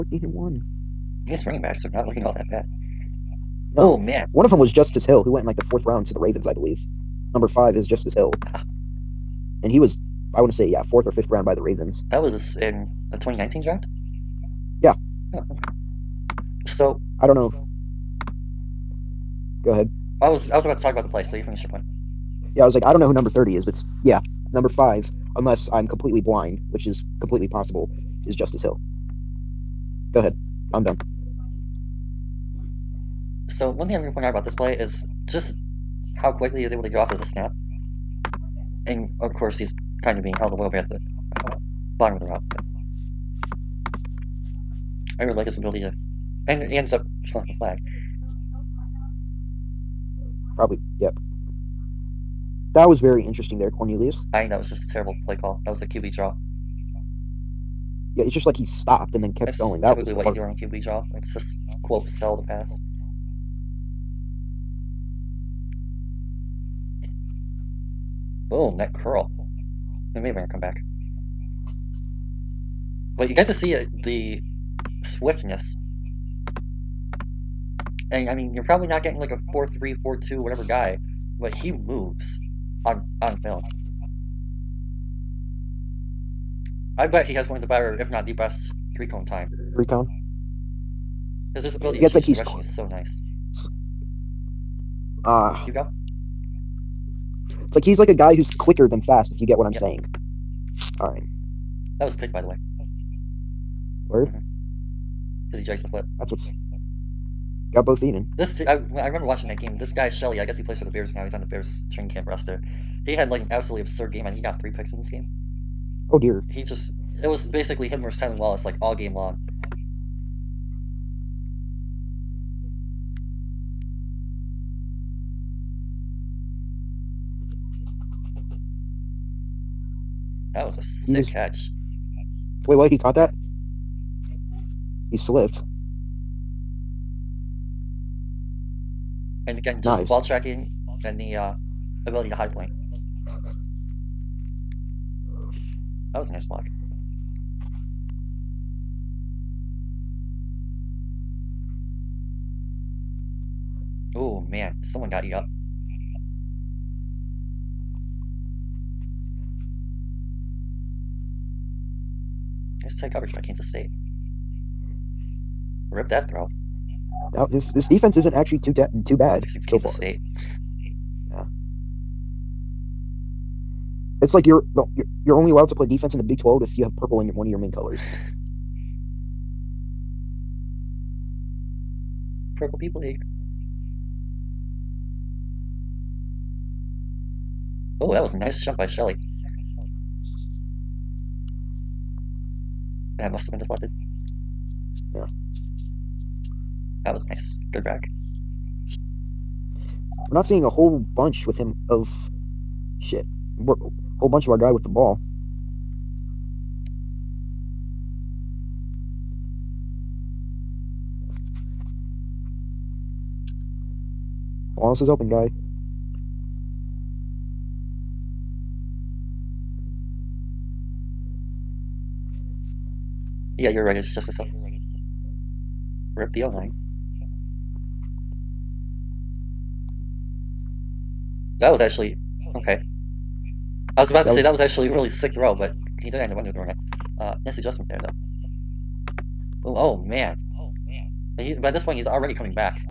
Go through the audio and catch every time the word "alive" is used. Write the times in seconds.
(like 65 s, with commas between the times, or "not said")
not said.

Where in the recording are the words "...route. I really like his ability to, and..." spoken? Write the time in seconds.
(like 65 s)
42 s.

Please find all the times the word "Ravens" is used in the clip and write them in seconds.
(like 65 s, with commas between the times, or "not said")
6 s, 11 s.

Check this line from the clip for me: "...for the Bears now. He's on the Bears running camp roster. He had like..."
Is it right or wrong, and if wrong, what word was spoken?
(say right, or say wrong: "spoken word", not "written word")
wrong: "training", not "running".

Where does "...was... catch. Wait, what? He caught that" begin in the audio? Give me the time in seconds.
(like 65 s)
131 s.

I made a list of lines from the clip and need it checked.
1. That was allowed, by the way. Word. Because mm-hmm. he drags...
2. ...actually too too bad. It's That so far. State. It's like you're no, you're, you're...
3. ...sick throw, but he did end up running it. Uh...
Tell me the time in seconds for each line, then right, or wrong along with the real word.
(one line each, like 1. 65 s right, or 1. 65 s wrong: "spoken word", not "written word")
1. 101 s wrong: "picked", not "allowed"
2. 168 s wrong: "Kansas", not "That"
3. 235 s wrong: "underthrowing", not "running".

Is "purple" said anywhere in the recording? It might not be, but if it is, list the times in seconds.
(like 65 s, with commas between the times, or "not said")
176 s, 182 s.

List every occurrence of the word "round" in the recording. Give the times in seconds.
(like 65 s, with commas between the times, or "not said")
5 s, 11 s.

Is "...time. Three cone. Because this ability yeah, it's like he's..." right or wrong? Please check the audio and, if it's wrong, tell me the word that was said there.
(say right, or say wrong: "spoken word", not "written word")
right.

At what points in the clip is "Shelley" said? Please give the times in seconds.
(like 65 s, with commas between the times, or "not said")
110 s, 188 s.